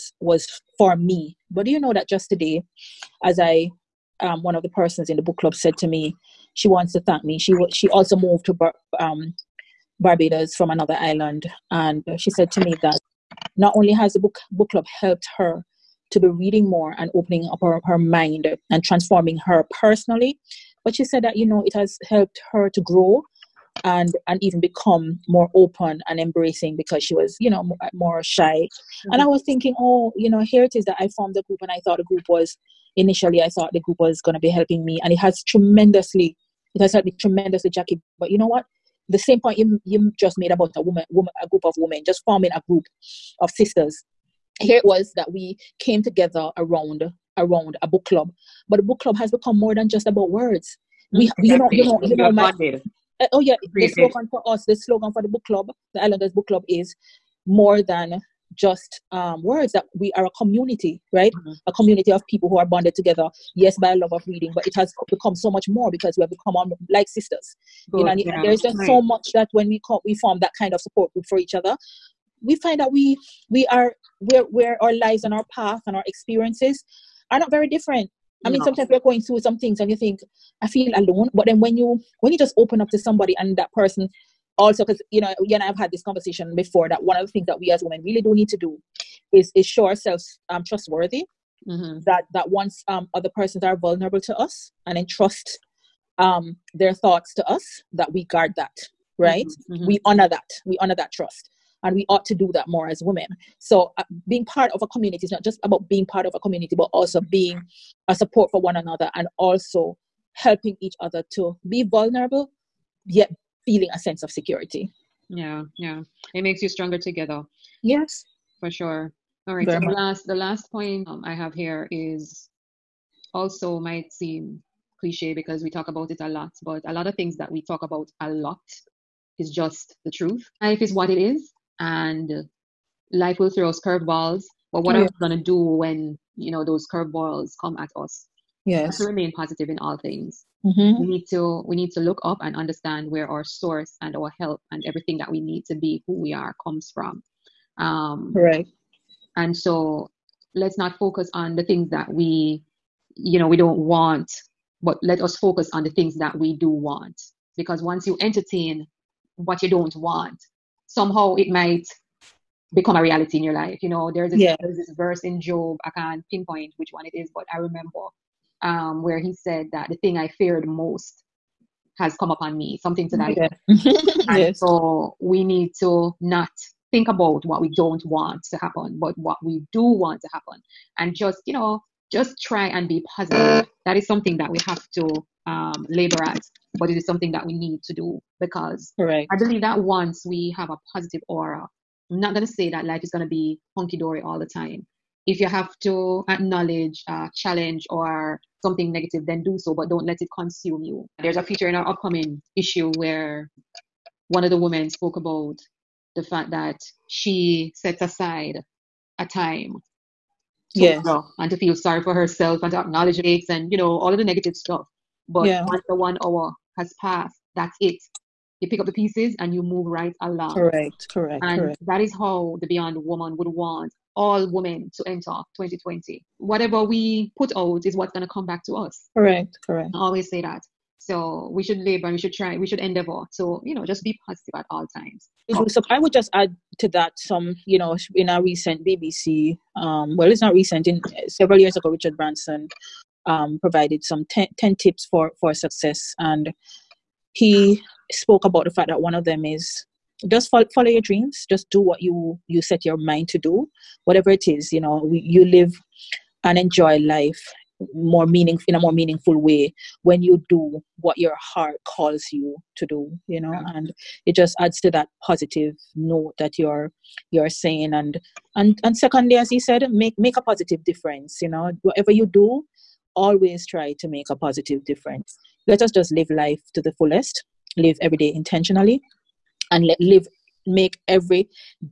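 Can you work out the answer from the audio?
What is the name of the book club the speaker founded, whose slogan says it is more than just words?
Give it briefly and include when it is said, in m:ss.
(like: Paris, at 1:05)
Islanders Book Club, at 0:56.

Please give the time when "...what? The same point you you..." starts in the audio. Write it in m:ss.
0:38.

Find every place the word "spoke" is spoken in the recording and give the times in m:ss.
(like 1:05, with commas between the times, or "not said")
3:24, 4:08.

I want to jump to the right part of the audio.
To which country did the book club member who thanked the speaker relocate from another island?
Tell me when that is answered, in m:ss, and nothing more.
0:10.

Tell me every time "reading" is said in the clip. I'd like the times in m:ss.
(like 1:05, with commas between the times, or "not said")
0:16, 1:04.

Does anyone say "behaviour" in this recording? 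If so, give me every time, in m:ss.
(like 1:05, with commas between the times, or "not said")
not said.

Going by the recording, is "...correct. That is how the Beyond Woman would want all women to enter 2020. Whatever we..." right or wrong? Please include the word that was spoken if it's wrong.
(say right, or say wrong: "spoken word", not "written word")
right.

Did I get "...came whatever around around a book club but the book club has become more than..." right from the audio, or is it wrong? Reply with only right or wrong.
wrong.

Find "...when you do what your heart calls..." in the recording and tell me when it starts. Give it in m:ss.
4:20.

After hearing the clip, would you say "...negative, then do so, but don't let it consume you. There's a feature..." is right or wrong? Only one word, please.
right.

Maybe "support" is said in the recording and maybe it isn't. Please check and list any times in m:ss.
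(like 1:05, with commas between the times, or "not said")
1:10, 1:48.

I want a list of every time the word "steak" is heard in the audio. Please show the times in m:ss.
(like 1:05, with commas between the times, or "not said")
not said.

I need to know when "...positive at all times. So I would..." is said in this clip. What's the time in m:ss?
3:54.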